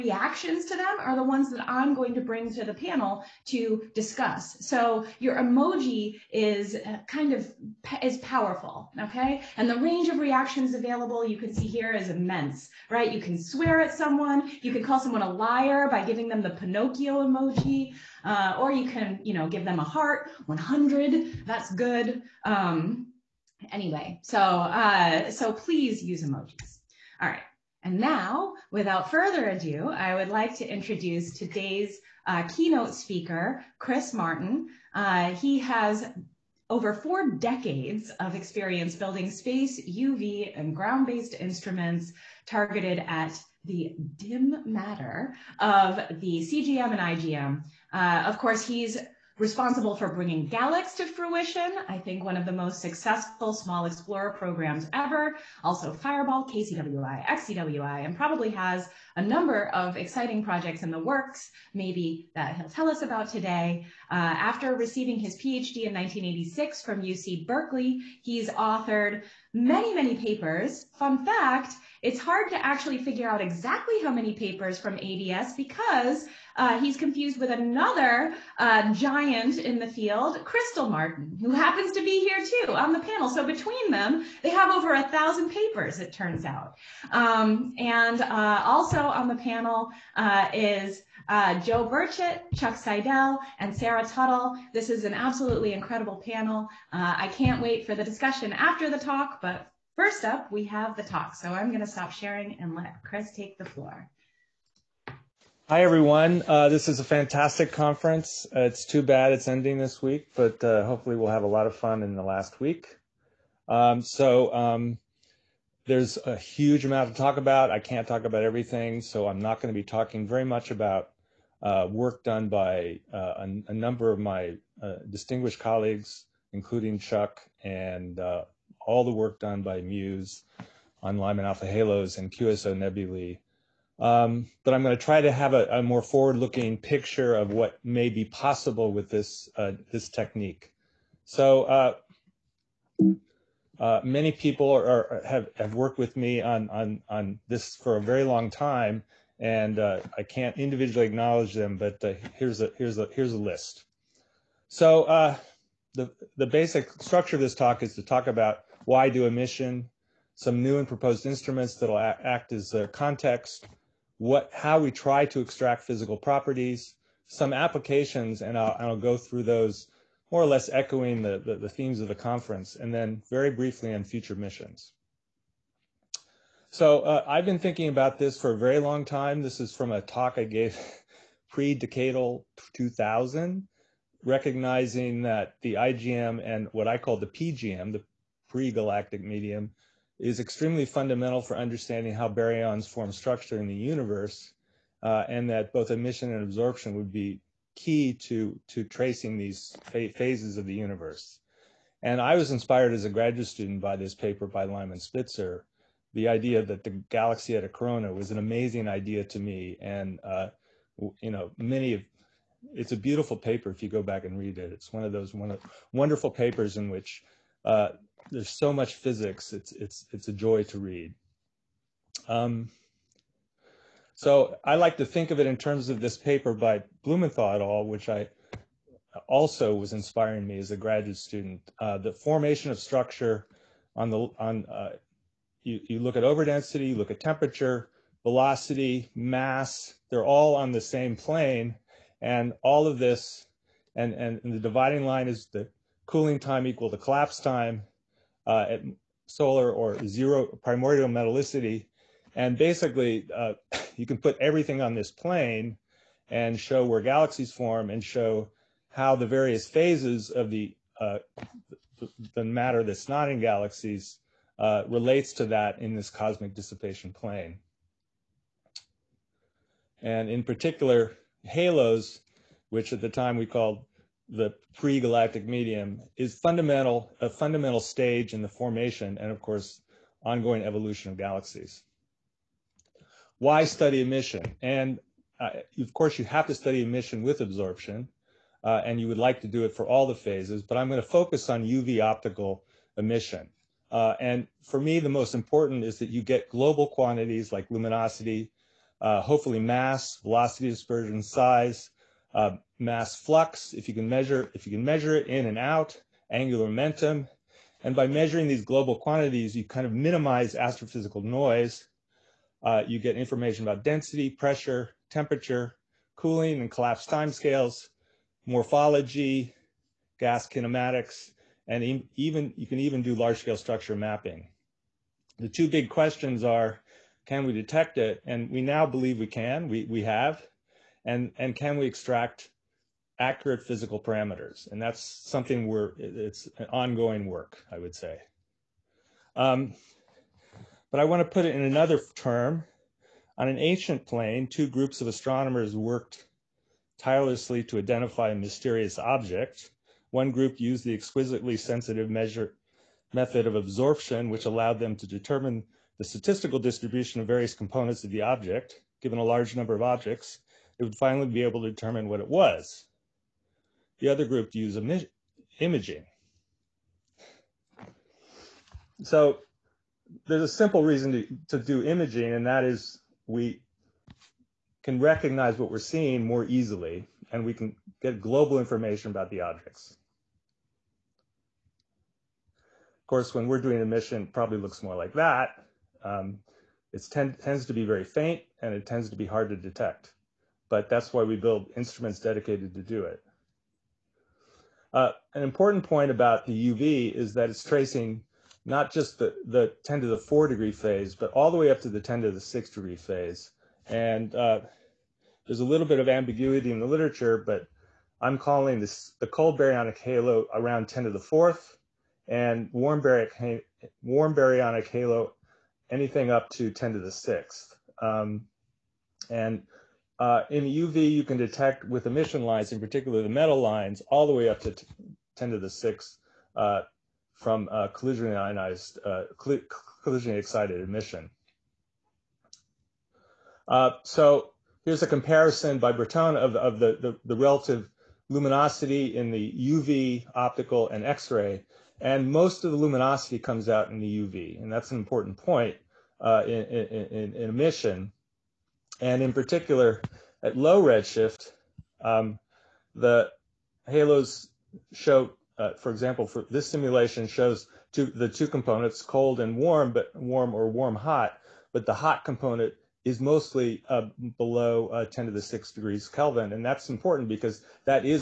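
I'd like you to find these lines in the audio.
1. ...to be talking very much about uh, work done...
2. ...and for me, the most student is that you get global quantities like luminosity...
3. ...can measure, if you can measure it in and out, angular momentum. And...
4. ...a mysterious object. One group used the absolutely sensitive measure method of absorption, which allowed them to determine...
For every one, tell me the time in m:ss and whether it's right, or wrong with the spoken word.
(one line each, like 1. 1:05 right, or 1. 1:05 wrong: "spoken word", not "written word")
1. 1:59 right
2. 4:54 wrong: "important", not "student"
3. 5:03 right
4. 5:48 wrong: "exquisitely", not "absolutely".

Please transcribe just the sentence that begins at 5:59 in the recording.
Given a large number of objects, it would finally be able to determine what it was.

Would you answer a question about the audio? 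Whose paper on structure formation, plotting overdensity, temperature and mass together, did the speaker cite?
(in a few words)
Blumenthal et al.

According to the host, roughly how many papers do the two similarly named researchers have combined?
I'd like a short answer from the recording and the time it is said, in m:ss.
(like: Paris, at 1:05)
over a thousand, at 1:24.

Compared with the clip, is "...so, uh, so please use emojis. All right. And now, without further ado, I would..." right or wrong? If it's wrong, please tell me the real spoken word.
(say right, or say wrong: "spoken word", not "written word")
right.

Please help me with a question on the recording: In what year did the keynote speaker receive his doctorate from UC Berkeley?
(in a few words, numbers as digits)
1986.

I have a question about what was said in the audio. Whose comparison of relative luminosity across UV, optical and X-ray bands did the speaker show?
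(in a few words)
Bertone.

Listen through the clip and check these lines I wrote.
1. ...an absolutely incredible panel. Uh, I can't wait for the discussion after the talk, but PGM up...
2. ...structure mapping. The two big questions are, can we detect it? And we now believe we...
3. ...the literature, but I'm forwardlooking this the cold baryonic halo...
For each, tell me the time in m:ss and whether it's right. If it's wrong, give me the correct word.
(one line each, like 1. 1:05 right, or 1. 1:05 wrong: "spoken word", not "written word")
1. 1:35 wrong: "First", not "PGM"
2. 5:23 right
3. 6:46 wrong: "calling", not "forwardlooking".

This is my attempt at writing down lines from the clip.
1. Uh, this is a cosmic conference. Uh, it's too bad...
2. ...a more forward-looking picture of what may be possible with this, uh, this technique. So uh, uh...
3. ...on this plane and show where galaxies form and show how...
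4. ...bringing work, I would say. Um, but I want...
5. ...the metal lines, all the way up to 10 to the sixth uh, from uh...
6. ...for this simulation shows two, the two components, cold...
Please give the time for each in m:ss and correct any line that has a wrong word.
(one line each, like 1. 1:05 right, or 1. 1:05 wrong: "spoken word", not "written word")
1. 1:46 wrong: "fantastic", not "cosmic"
2. 2:15 right
3. 4:14 right
4. 5:36 wrong: "ongoing", not "bringing"
5. 7:03 right
6. 7:36 right.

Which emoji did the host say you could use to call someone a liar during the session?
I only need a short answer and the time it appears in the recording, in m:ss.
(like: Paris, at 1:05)
Pinocchio, at 0:16.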